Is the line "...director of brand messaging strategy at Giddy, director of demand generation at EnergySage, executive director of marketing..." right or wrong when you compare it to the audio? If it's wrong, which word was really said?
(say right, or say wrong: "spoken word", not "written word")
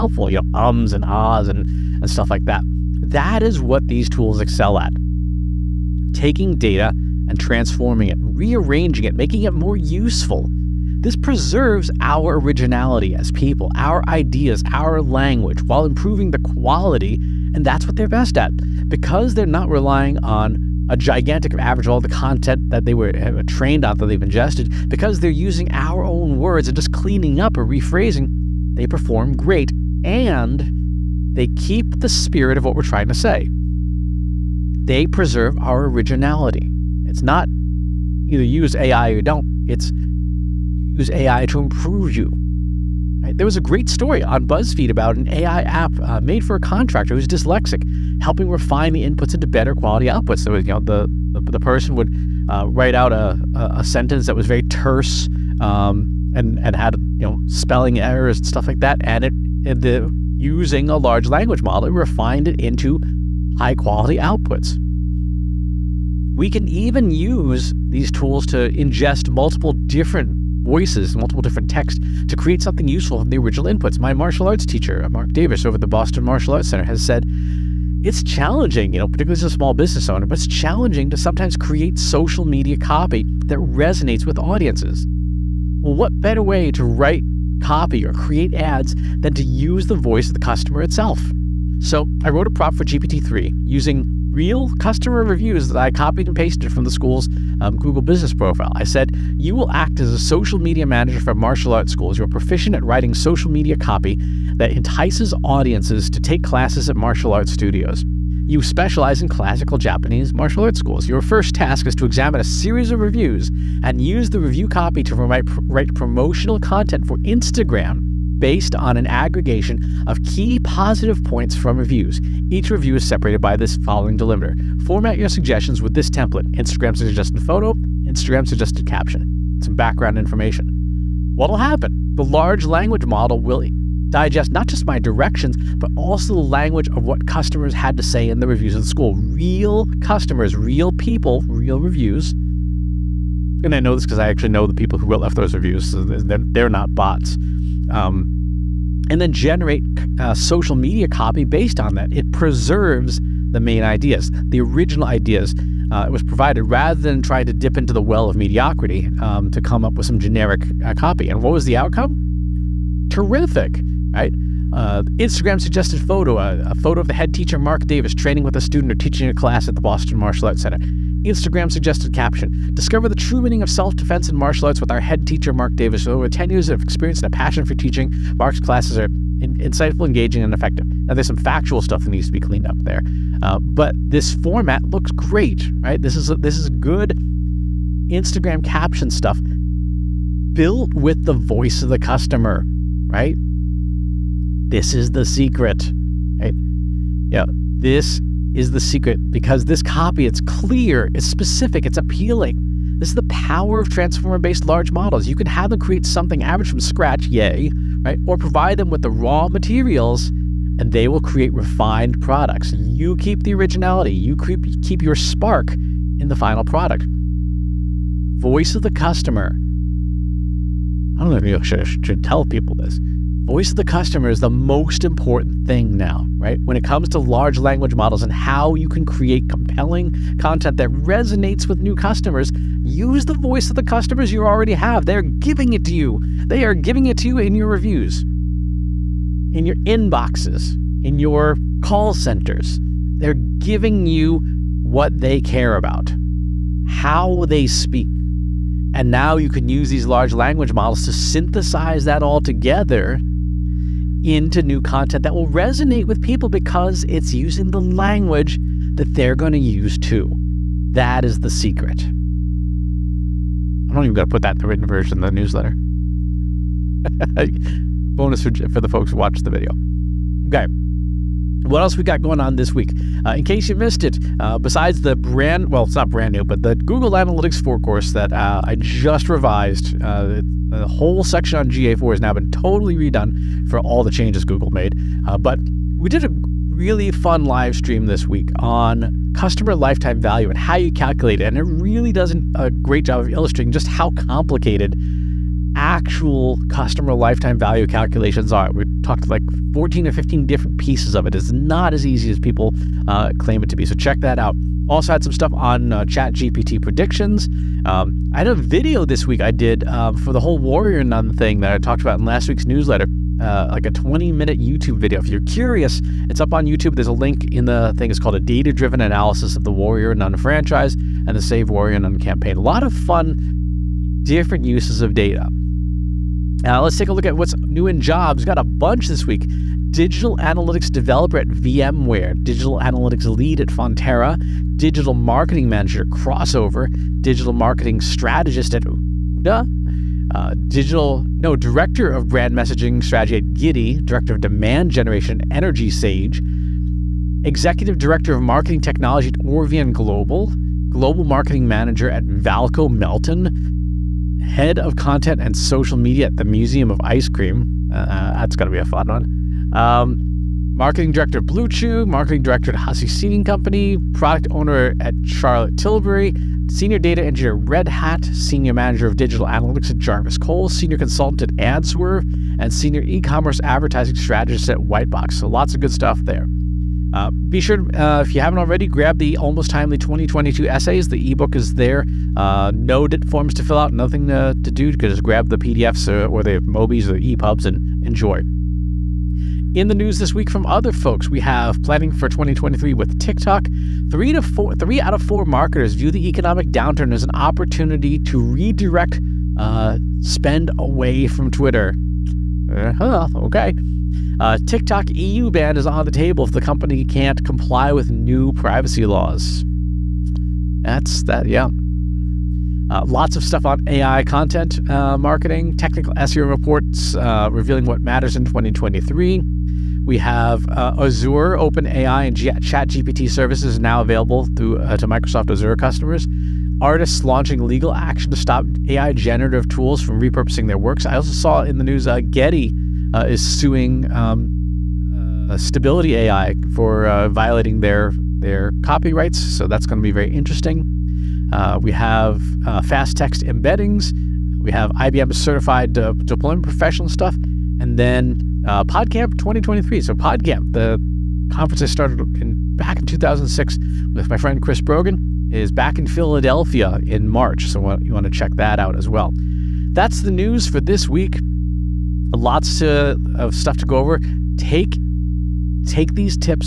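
right.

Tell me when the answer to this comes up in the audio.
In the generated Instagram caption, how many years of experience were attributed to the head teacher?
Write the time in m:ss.
2:56.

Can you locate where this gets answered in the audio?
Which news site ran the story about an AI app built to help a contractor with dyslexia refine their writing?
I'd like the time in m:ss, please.
0:44.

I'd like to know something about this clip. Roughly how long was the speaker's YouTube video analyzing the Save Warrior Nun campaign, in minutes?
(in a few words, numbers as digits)
20.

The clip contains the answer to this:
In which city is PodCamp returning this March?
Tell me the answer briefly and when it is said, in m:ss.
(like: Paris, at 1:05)
Philadelphia, at 7:36.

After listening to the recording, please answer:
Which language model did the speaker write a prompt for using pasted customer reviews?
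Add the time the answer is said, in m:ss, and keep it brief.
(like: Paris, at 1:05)
GPT-3, at 1:32.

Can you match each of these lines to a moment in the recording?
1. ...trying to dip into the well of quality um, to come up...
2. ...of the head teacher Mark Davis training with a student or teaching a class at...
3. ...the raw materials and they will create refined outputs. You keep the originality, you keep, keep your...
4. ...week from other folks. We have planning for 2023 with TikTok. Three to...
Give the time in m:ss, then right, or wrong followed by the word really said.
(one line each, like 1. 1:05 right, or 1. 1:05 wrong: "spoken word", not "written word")
1. 2:37 wrong: "mediocrity", not "quality"
2. 2:47 right
3. 3:29 wrong: "products", not "outputs"
4. 6:30 right.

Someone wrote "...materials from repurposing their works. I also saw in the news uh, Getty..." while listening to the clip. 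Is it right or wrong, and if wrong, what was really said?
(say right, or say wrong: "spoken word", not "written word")
wrong: "tools", not "materials".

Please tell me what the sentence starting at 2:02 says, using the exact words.
Each review is separated by this following delimiter.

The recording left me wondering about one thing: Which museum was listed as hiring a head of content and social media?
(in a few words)
Museum of Ice Cream.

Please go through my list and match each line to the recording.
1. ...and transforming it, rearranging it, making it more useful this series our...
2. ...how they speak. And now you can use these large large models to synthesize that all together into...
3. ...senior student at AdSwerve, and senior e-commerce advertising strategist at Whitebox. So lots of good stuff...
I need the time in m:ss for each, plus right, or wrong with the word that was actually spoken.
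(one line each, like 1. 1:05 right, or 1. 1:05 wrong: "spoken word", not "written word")
1. 0:07 wrong: "preserves", not "series"
2. 4:06 wrong: "language", not "large"
3. 6:10 wrong: "consultant", not "student".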